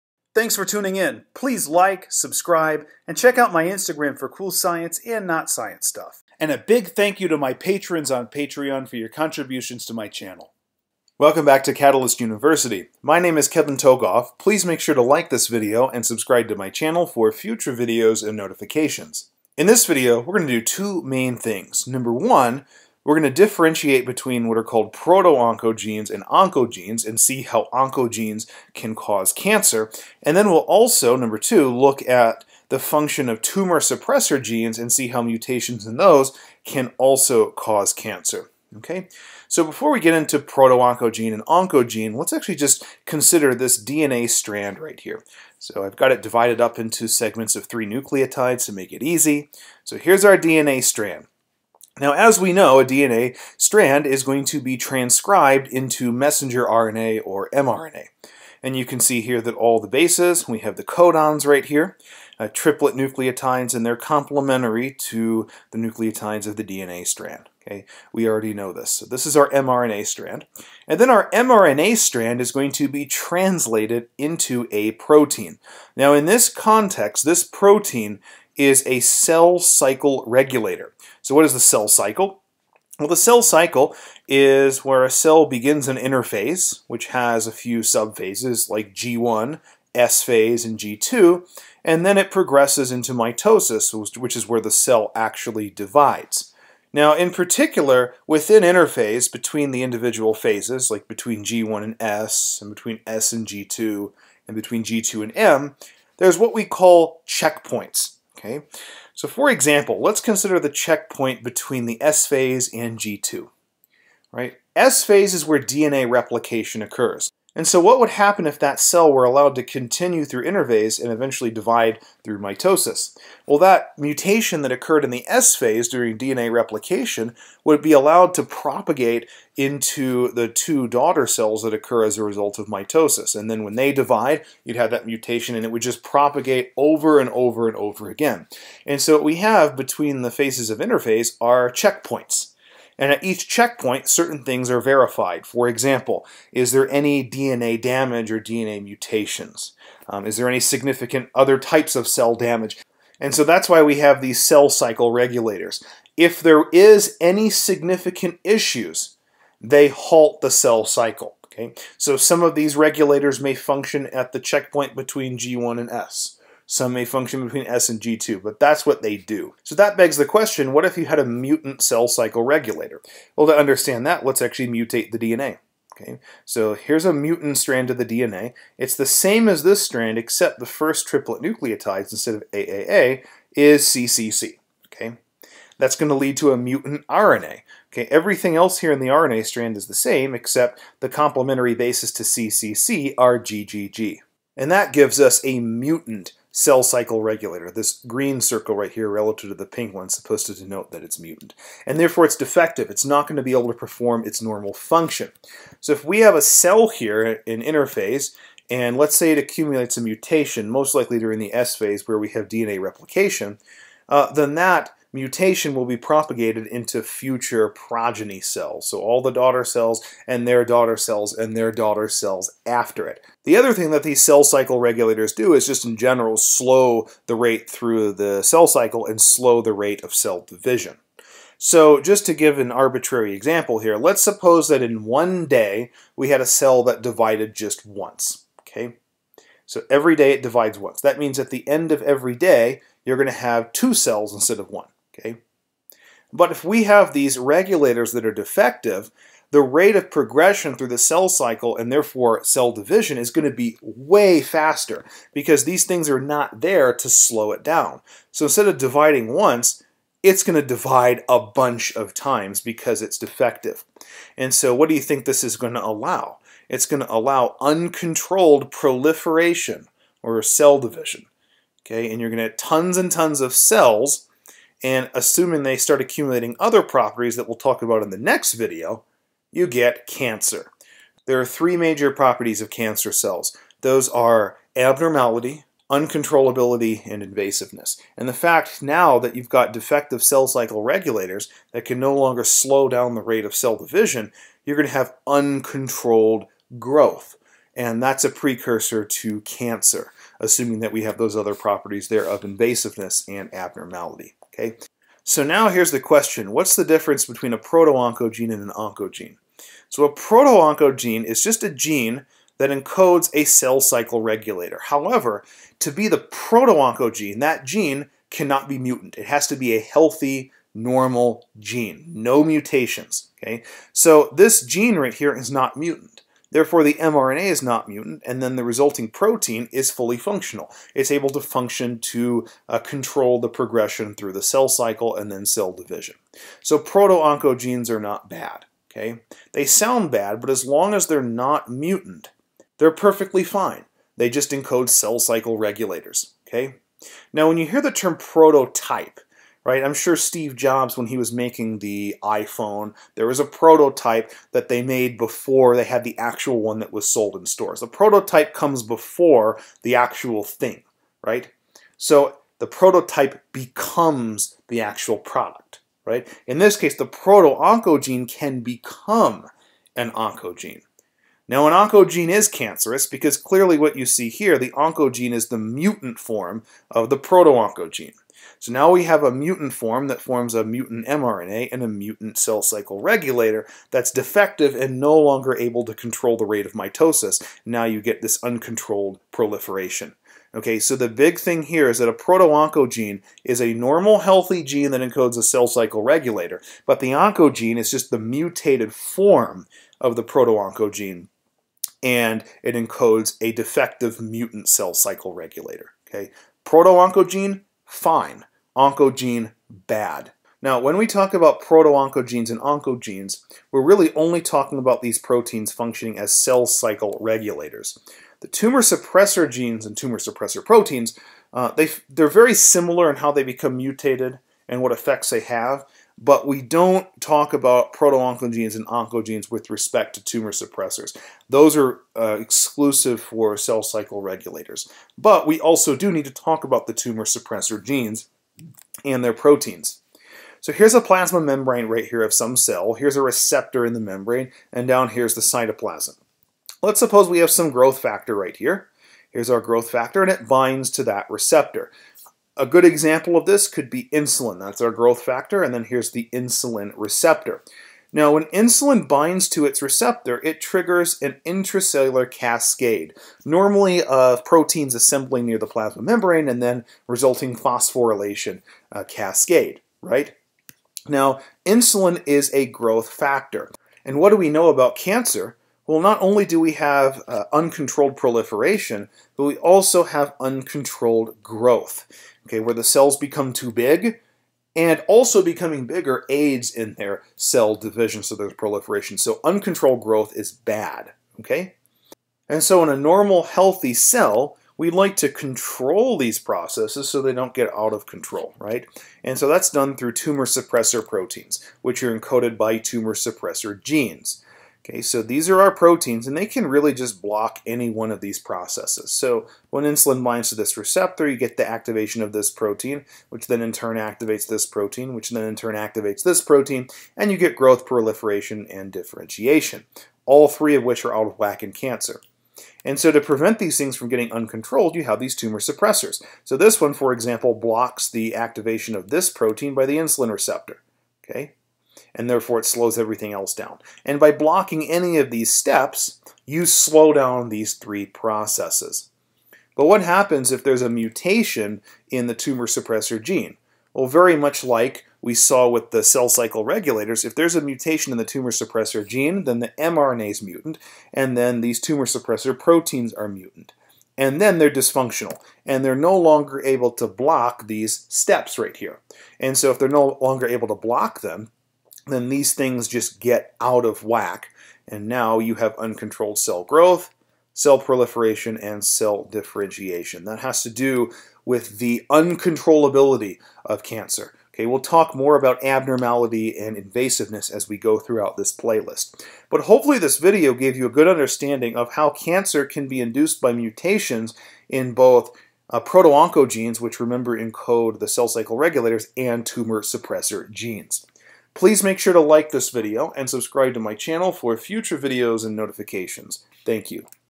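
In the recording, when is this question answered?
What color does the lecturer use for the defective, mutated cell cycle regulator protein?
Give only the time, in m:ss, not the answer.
3:18.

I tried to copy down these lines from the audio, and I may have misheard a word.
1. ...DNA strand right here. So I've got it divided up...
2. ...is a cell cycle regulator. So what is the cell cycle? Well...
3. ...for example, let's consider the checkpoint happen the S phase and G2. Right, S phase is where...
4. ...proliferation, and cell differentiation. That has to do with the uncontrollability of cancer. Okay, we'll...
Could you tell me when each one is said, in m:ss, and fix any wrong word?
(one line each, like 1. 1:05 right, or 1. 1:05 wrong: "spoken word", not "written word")
1. 0:43 right
2. 1:18 right
3. 1:49 wrong: "between", not "happen"
4. 9:27 right.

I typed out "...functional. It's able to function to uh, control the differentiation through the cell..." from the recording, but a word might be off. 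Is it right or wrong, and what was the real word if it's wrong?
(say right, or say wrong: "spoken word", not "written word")
wrong: "progression", not "differentiation".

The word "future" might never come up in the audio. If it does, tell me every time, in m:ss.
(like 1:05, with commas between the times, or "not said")
0:17, 3:37, 9:54.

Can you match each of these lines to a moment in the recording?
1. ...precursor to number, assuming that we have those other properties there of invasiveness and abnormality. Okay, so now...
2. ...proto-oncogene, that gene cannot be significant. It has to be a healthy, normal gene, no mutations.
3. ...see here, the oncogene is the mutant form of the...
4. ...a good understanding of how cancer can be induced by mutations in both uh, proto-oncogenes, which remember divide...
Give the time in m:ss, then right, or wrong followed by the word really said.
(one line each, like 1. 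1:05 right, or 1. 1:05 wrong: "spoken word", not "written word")
1. 4:58 wrong: "cancer", not "number"
2. 5:16 wrong: "mutant", not "significant"
3. 6:14 right
4. 9:40 wrong: "encode", not "divide".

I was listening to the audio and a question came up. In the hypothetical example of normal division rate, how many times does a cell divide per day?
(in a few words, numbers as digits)
1.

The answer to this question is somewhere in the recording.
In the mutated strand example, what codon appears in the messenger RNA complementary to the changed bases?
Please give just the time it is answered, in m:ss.
3:13.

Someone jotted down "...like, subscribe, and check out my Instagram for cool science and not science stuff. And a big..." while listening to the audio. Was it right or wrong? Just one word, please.
right.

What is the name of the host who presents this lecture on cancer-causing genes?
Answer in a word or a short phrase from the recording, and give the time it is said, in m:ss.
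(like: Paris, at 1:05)
Kevin Tokoph, at 0:13.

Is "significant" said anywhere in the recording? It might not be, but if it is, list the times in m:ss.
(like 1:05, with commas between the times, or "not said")
2:30, 2:37.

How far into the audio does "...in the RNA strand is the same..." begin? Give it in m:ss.
3:08.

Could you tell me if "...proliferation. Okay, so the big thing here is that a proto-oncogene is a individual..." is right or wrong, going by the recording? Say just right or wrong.
wrong.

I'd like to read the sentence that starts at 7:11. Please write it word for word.
Those are uh, exclusive for cell cycle regulators.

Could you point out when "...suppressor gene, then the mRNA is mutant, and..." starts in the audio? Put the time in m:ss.
9:08.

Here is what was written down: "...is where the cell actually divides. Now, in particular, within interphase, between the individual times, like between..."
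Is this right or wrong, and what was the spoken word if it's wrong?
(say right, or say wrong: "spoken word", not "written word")
wrong: "phases", not "times".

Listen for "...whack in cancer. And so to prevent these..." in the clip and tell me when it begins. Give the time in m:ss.
8:41.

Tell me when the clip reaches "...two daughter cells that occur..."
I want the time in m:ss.
2:10.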